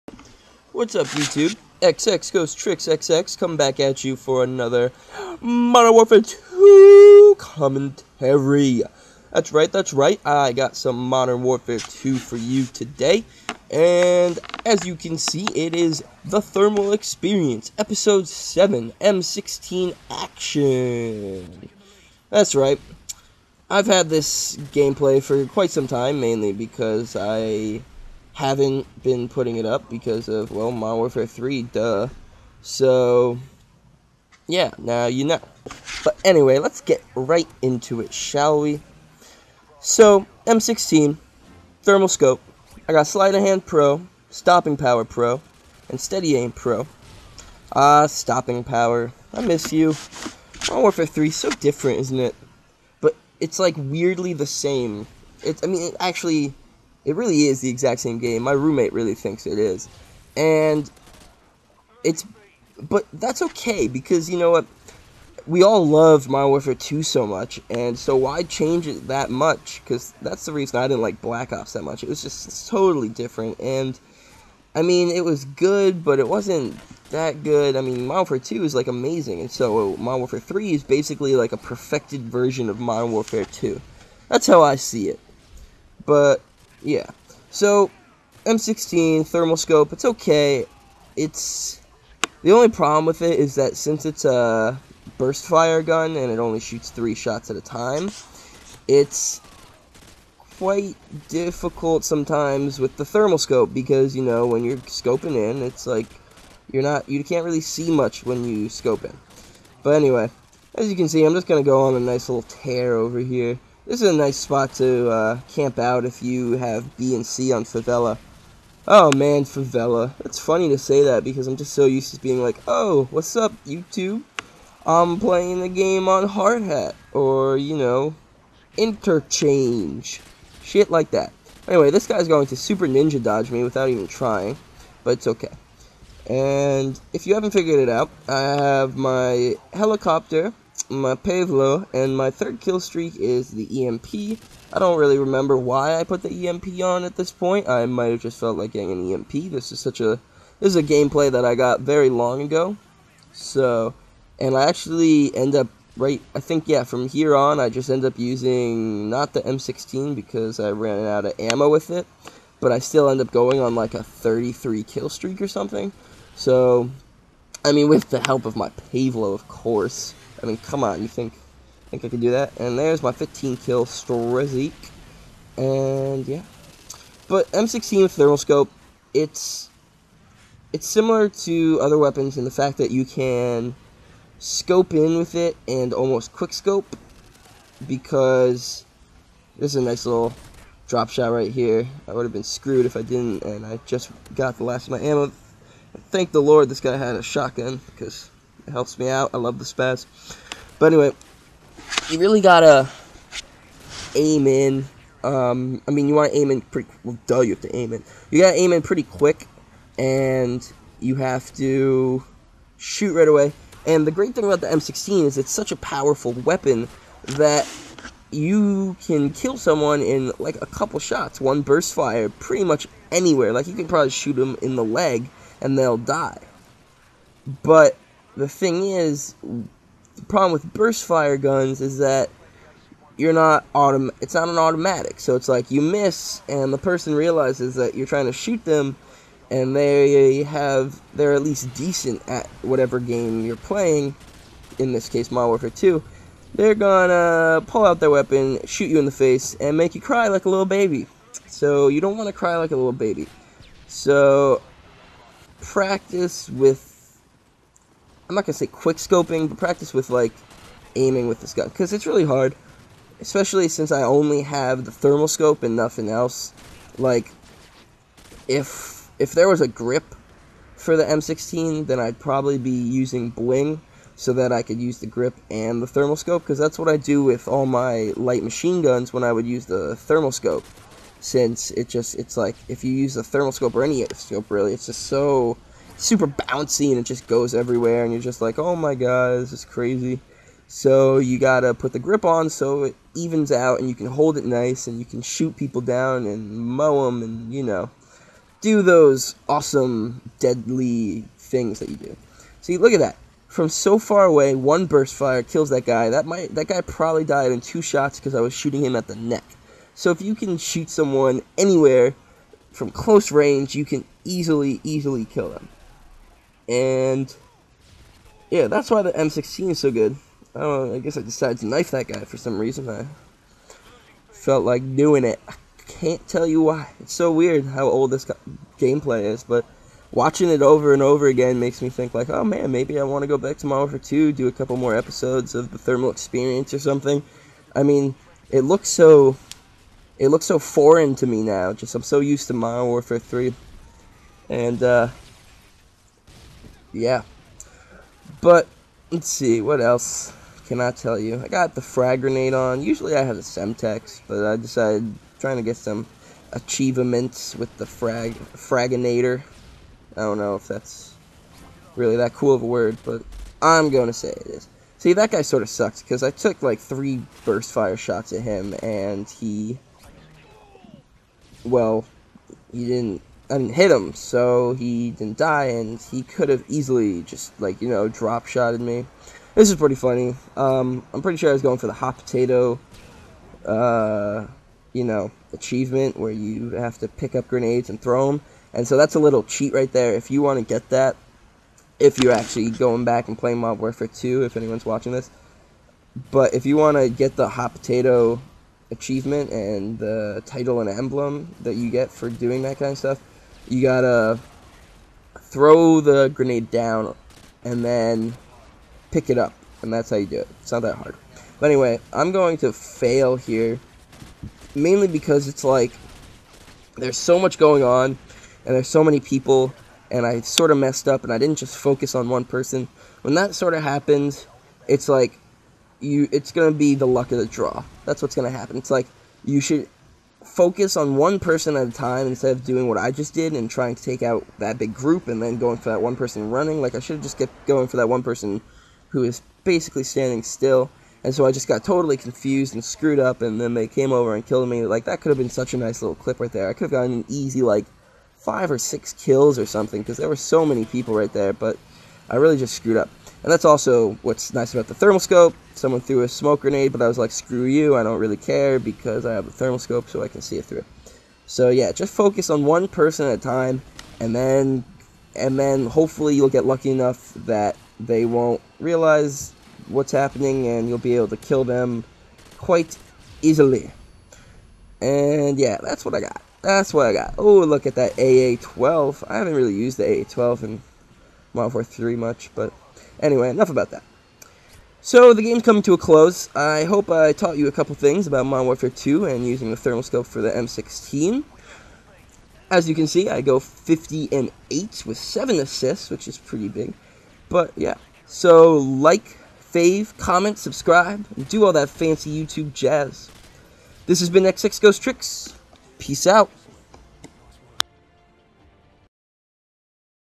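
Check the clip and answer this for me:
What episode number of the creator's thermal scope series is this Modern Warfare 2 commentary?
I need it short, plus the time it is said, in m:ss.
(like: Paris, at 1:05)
7, at 0:17.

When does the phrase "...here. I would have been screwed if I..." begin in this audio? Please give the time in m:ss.
3:11.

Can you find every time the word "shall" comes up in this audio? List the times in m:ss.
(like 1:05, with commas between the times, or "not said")
0:38.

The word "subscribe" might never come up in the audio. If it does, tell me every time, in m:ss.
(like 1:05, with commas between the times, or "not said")
8:20.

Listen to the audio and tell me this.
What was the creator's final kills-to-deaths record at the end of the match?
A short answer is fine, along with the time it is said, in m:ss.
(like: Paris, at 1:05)
50 and 8, at 8:13.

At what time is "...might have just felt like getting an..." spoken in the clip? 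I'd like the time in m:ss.
2:27.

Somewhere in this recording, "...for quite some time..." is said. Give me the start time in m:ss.
0:25.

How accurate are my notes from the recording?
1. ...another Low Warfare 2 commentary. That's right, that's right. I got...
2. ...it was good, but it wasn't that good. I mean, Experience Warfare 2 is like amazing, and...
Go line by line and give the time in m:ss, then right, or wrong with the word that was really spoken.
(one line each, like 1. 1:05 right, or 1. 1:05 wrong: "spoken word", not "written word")
1. 0:04 wrong: "Modern", not "Low"
2. 1:15 wrong: "Modern", not "Experience".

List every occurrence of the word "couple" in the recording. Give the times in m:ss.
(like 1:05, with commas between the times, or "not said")
3:40, 5:34, 8:07.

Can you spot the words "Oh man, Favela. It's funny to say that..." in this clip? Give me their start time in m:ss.
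1:58.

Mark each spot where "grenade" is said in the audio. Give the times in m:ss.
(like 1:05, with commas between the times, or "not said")
5:52, 6:27, 6:46, 7:36.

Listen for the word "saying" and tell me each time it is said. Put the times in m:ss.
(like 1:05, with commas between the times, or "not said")
not said.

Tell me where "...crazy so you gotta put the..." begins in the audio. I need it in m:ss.
4:49.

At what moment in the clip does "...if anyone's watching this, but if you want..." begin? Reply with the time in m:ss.
6:34.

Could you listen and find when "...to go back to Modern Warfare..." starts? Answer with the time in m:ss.
5:33.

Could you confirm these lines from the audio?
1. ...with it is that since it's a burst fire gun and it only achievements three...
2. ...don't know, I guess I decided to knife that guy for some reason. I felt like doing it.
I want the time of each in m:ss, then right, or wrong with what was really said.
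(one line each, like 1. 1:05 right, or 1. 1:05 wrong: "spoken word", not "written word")
1. 1:33 wrong: "shoots", not "achievements"
2. 5:20 right.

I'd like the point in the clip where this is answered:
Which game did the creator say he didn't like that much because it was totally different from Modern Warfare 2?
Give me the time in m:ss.
1:11.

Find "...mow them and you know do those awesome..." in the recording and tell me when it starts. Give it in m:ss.
4:56.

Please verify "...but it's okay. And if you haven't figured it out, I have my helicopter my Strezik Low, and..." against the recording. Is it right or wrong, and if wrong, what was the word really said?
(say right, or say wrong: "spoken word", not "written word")
wrong: "Pave", not "Strezik".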